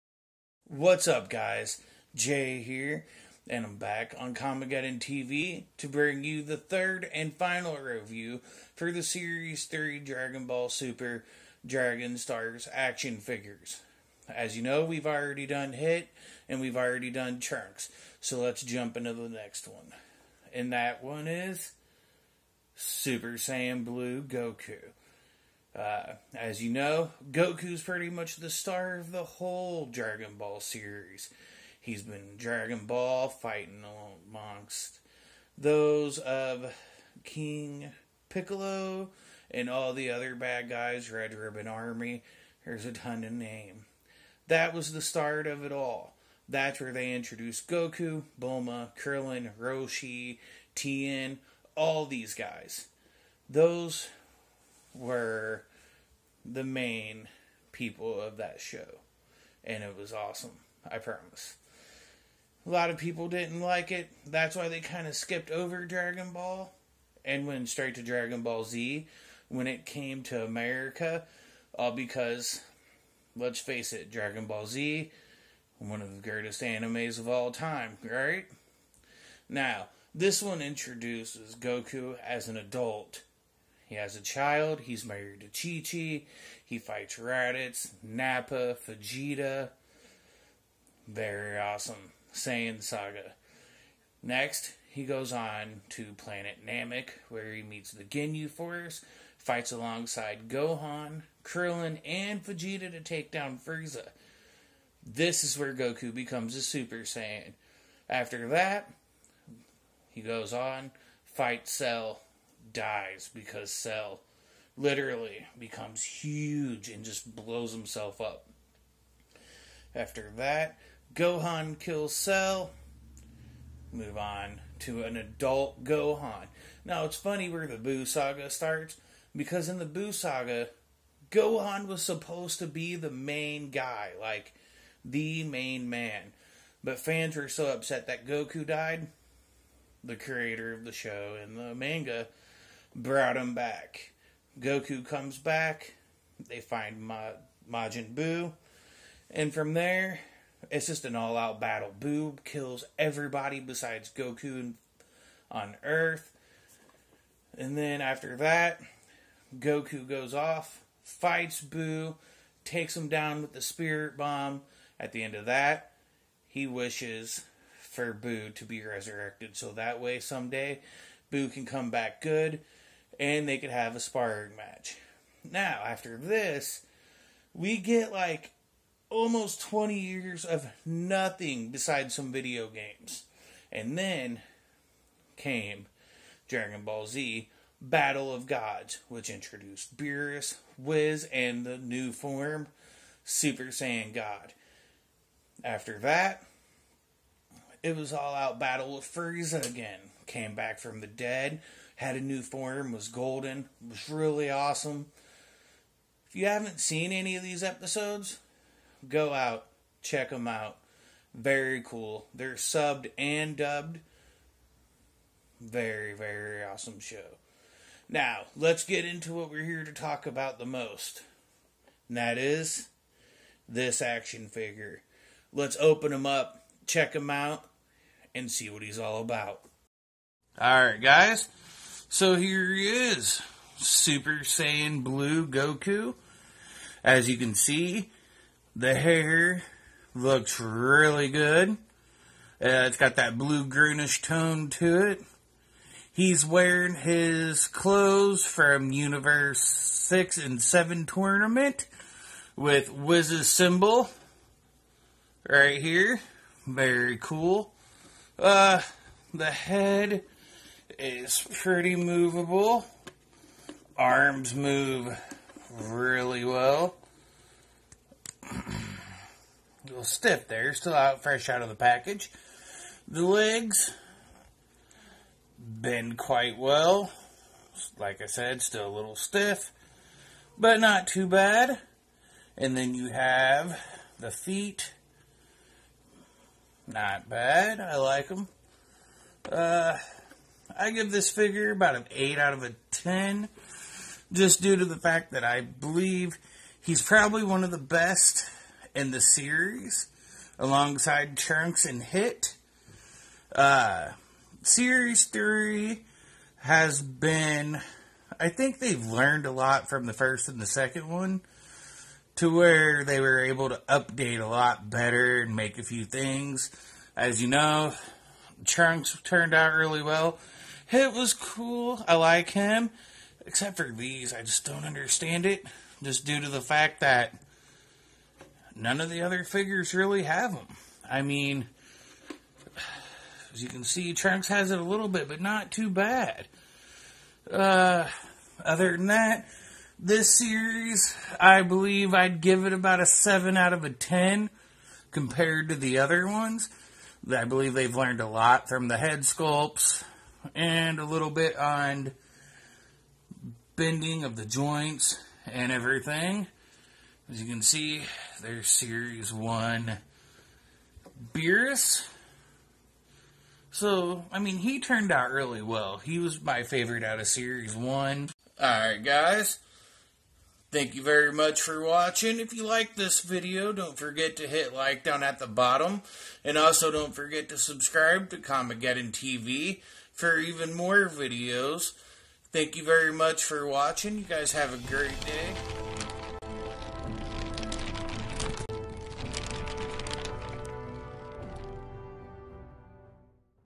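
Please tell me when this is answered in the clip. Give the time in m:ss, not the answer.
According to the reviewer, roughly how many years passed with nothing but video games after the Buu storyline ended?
2:59.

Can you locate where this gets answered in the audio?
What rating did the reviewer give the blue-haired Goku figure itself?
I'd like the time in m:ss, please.
4:52.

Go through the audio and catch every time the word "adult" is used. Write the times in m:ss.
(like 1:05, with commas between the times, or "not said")
1:22, 2:05.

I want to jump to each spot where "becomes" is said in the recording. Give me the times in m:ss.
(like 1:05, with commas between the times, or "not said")
1:46, 1:55.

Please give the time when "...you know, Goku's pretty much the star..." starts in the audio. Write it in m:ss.
0:26.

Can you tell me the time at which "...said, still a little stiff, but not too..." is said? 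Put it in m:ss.
4:38.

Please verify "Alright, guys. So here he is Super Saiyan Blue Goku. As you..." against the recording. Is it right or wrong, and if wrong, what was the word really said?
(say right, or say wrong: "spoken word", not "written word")
right.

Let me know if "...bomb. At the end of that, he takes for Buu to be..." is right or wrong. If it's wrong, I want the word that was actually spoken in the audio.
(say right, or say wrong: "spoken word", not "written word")
wrong: "wishes", not "takes".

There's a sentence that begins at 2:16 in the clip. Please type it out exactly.
But fans were so upset that Goku died, the creator of the show and the manga brought him back.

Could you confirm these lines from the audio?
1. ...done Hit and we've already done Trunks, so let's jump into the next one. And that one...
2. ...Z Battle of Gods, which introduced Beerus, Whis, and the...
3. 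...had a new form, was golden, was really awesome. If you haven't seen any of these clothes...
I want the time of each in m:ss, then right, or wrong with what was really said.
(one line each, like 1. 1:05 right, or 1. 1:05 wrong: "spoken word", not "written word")
1. 0:15 right
2. 3:07 right
3. 3:21 wrong: "episodes", not "clothes".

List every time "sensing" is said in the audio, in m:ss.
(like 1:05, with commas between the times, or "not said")
not said.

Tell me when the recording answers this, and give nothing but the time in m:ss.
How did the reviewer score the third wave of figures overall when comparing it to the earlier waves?
5:43.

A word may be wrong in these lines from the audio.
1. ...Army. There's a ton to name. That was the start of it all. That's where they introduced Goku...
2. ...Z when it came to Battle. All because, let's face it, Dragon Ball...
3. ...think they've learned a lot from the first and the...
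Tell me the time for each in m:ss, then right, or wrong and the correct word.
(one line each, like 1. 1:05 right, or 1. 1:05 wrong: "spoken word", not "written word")
1. 0:41 right
2. 1:08 wrong: "America", not "Battle"
3. 5:08 right.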